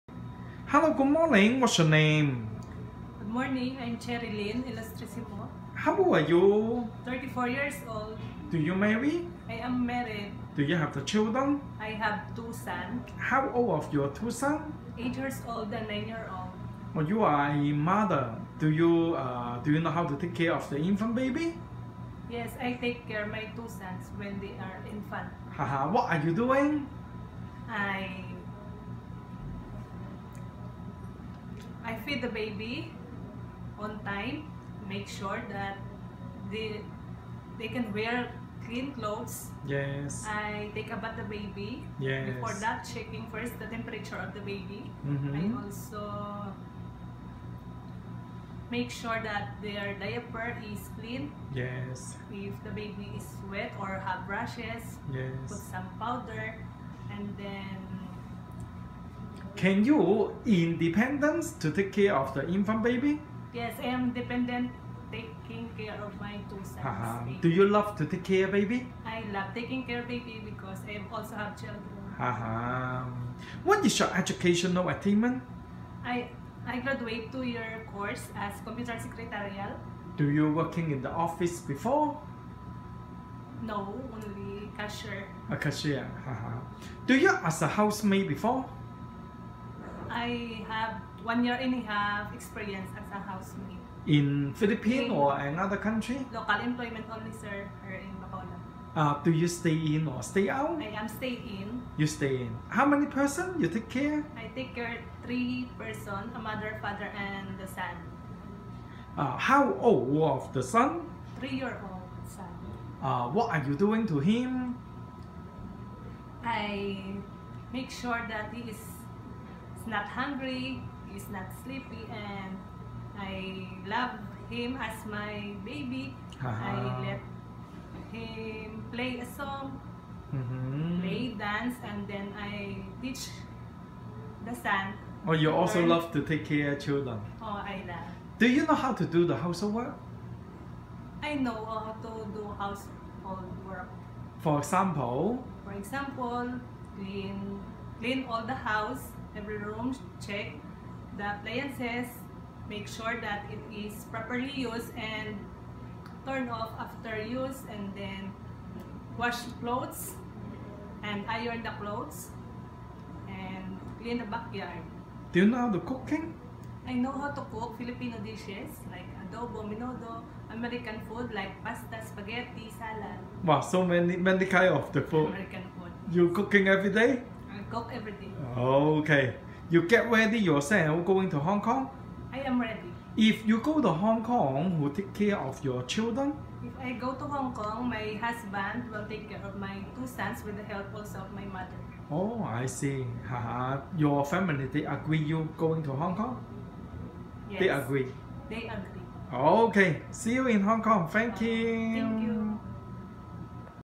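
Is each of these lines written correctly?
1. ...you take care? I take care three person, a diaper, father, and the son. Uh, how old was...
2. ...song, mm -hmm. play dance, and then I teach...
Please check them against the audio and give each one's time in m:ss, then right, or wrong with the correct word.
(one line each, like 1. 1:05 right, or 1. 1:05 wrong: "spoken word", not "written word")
1. 1:43 wrong: "mother", not "diaper"
2. 2:09 right.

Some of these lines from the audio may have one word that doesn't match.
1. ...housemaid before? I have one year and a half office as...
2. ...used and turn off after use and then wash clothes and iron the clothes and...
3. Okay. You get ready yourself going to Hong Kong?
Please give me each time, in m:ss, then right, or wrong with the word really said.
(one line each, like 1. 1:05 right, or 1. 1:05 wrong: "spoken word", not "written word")
1. 1:27 wrong: "experience", not "office"
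2. 2:34 right
3. 2:58 right.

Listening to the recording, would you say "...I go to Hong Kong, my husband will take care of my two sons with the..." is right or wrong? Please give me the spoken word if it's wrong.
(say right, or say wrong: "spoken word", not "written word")
right.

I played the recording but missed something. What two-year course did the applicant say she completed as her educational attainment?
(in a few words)
Computer secretarial.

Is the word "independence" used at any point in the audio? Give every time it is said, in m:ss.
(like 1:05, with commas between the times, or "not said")
1:00.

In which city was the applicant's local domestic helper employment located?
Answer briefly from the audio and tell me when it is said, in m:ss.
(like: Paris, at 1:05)
Bacolod, at 1:38.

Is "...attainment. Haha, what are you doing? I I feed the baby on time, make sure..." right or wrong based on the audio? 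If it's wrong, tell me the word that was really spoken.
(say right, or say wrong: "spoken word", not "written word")
wrong: "infant", not "attainment".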